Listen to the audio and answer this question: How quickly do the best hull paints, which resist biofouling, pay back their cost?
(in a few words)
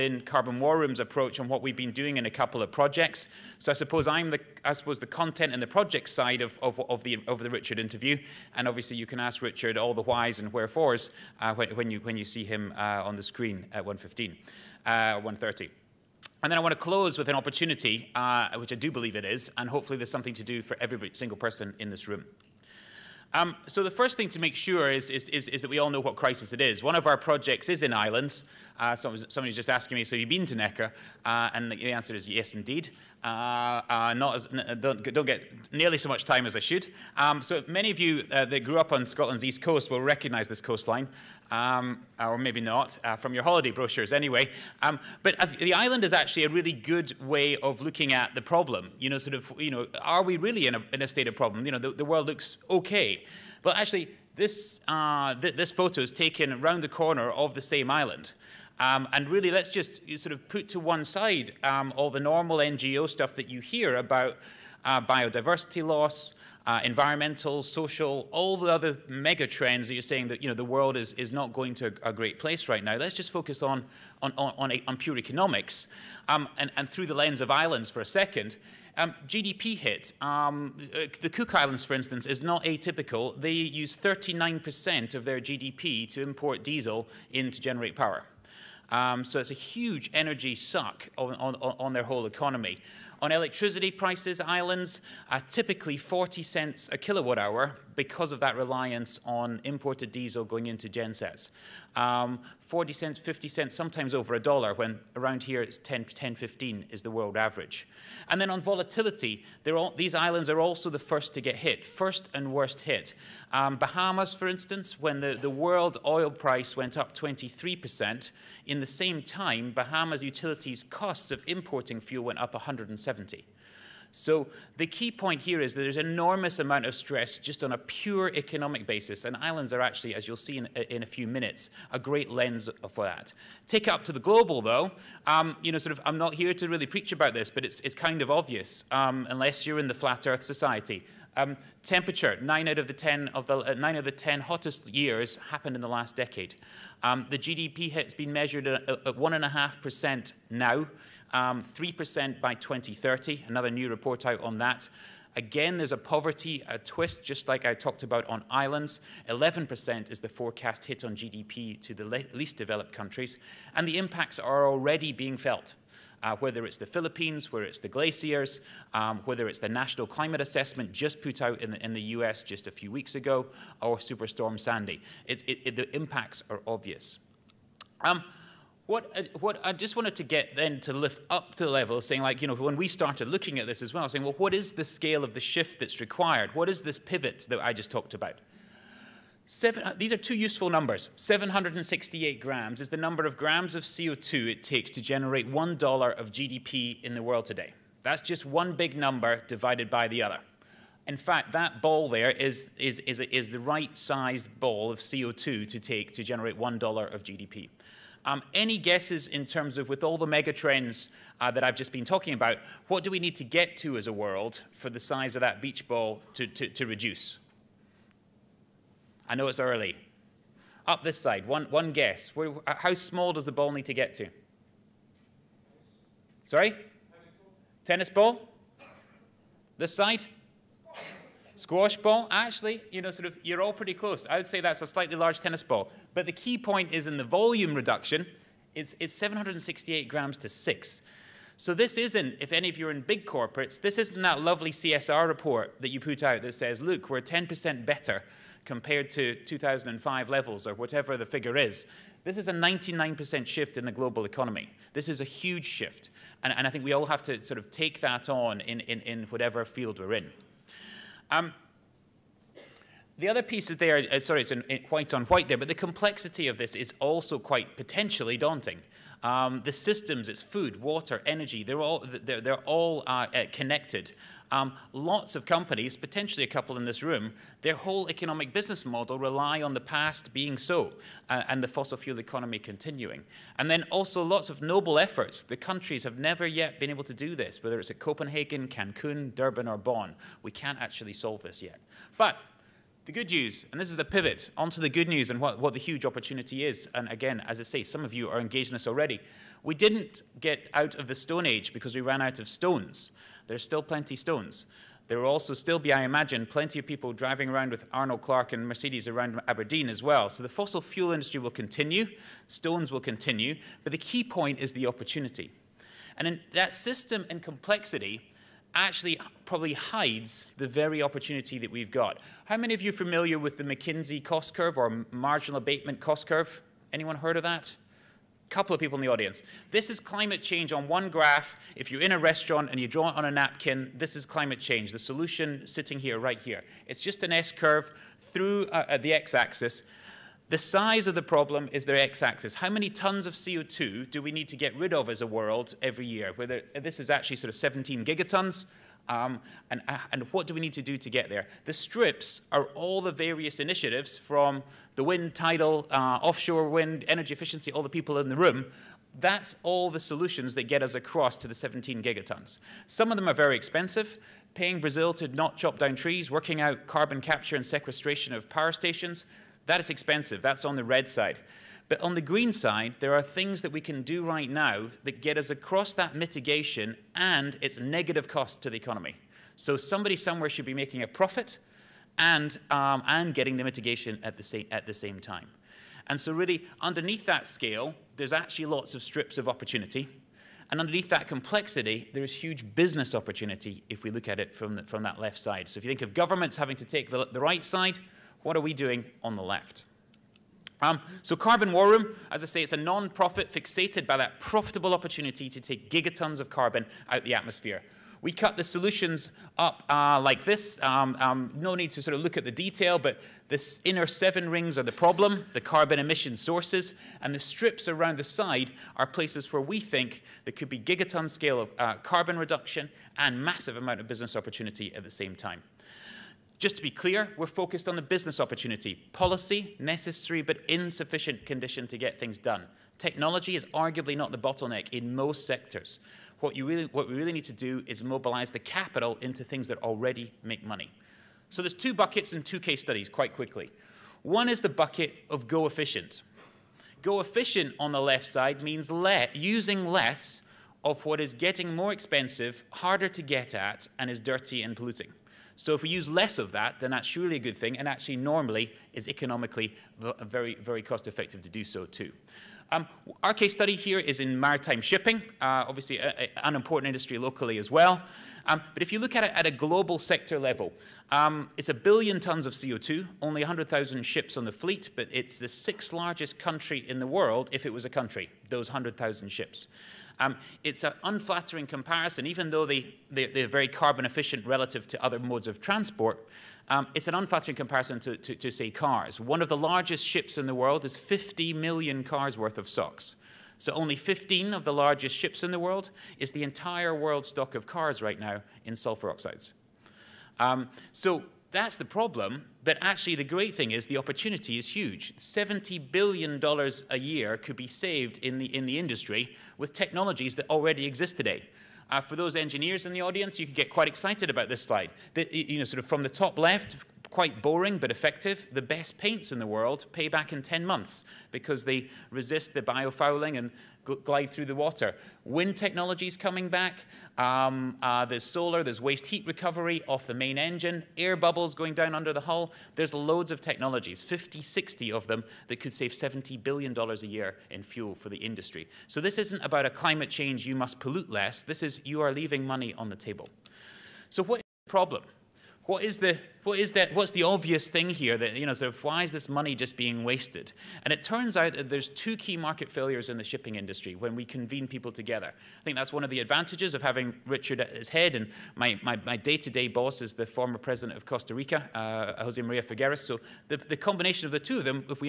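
10 months.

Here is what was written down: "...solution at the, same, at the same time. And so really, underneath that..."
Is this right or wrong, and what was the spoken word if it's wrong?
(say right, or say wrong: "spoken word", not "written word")
wrong: "mitigation", not "solution".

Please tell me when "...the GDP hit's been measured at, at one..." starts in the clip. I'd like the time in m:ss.
2:27.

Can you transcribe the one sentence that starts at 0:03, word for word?
So I suppose I'm the, I suppose the content and the project side of, of, of, the, of the Richard interview.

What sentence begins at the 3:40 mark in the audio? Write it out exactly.
Up this side, one, one guess.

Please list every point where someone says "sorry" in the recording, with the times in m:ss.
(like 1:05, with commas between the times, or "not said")
3:46, 4:24.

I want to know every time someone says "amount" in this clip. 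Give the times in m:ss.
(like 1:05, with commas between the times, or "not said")
2:06, 7:03.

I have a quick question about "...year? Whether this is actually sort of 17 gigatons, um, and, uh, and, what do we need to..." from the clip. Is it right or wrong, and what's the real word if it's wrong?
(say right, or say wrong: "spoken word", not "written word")
right.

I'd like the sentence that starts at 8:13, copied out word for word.
So only 15 of the largest ships in the world is the entire world stock of cars right now in sulfur oxides.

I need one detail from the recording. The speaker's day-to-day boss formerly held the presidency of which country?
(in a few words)
Costa Rica.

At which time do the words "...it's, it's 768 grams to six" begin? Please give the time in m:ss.
3:58.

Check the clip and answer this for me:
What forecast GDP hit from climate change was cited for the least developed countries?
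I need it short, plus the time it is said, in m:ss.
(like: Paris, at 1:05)
11%, at 2:39.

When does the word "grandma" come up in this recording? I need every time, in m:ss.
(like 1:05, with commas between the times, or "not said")
not said.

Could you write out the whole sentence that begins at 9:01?
This is you are leaving money on the table.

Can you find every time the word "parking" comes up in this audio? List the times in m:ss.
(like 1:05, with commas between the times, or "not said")
not said.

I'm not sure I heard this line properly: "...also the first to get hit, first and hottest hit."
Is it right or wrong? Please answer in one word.
wrong.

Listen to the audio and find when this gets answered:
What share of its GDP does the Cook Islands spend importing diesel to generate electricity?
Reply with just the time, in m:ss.
1:23.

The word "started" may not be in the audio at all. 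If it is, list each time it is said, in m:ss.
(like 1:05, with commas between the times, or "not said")
3:02.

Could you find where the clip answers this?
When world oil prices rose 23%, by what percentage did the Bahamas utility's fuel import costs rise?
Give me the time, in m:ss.
2:02.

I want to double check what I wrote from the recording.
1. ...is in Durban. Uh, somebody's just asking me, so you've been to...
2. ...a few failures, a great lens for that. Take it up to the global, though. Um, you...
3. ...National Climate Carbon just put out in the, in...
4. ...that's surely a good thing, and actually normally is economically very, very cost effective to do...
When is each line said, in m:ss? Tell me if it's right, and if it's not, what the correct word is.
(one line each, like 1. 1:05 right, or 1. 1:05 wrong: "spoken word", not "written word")
1. 0:27 wrong: "Ireland", not "Durban"
2. 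2:11 wrong: "minutes", not "failures"
3. 2:49 wrong: "Assessment", not "Carbon"
4. 7:36 right.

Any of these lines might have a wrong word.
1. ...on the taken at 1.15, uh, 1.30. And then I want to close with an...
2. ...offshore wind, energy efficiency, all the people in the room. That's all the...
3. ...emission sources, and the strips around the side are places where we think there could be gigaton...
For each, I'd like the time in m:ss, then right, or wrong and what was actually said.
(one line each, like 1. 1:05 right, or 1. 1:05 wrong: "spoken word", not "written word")
1. 0:13 wrong: "screen", not "taken"
2. 5:56 right
3. 6:55 right.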